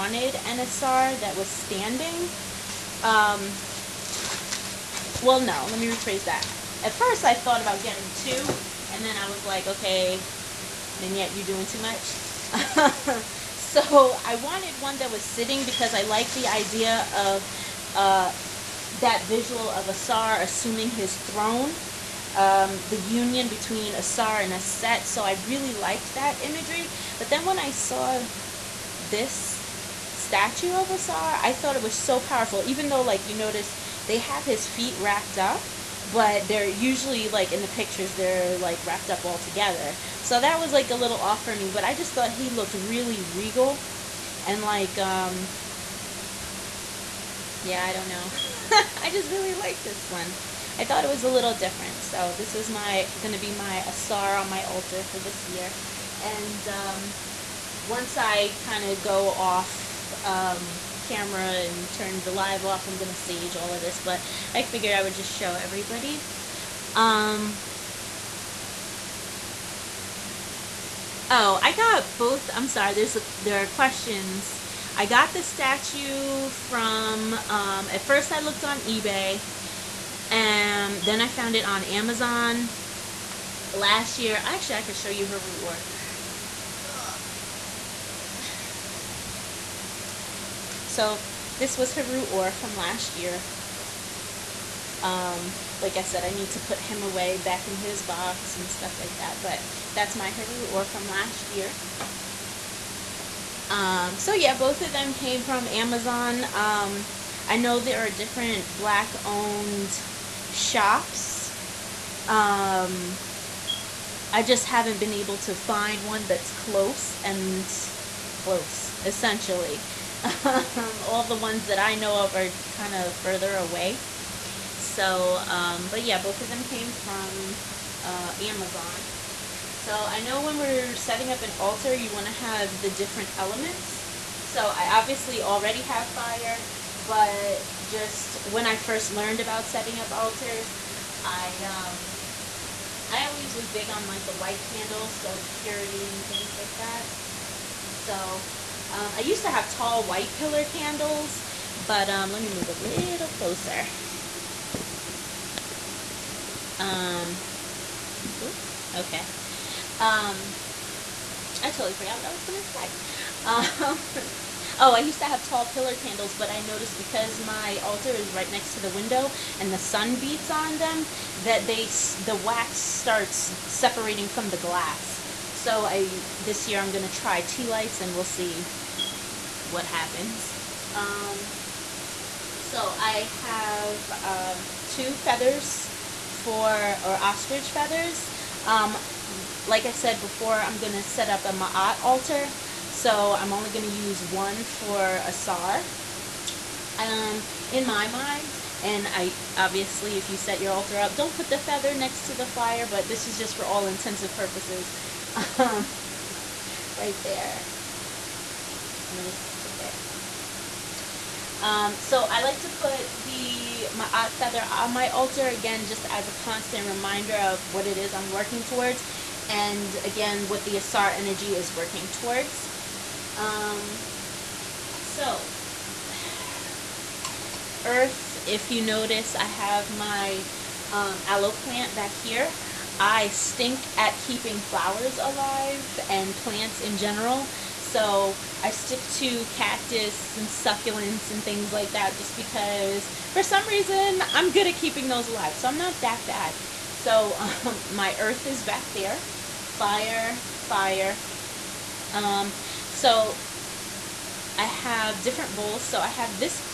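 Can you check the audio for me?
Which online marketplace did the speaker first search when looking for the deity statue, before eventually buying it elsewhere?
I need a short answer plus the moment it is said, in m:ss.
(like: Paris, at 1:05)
eBay, at 1:18.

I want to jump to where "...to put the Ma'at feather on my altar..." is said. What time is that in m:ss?
3:32.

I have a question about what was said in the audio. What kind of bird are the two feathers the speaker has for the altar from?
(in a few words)
Ostrich.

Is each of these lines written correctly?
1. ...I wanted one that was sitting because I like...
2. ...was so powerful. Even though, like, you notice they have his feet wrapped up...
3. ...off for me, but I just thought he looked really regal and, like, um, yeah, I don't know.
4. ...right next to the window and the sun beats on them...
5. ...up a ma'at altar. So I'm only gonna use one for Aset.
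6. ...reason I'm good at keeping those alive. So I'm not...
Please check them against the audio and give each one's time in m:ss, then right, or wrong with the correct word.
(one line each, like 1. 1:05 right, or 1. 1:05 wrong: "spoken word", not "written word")
1. 0:14 right
2. 0:31 right
3. 0:41 right
4. 2:48 right
5. 3:11 wrong: "Asar", not "Aset"
6. 4:03 right.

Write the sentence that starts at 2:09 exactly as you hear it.
So I know when we're setting up an altar, you want to have the different elements.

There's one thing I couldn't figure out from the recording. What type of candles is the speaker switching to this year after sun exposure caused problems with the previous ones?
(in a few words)
Tea lights.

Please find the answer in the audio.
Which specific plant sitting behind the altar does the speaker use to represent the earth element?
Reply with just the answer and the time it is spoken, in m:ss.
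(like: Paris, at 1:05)
Aloe plant, at 3:51.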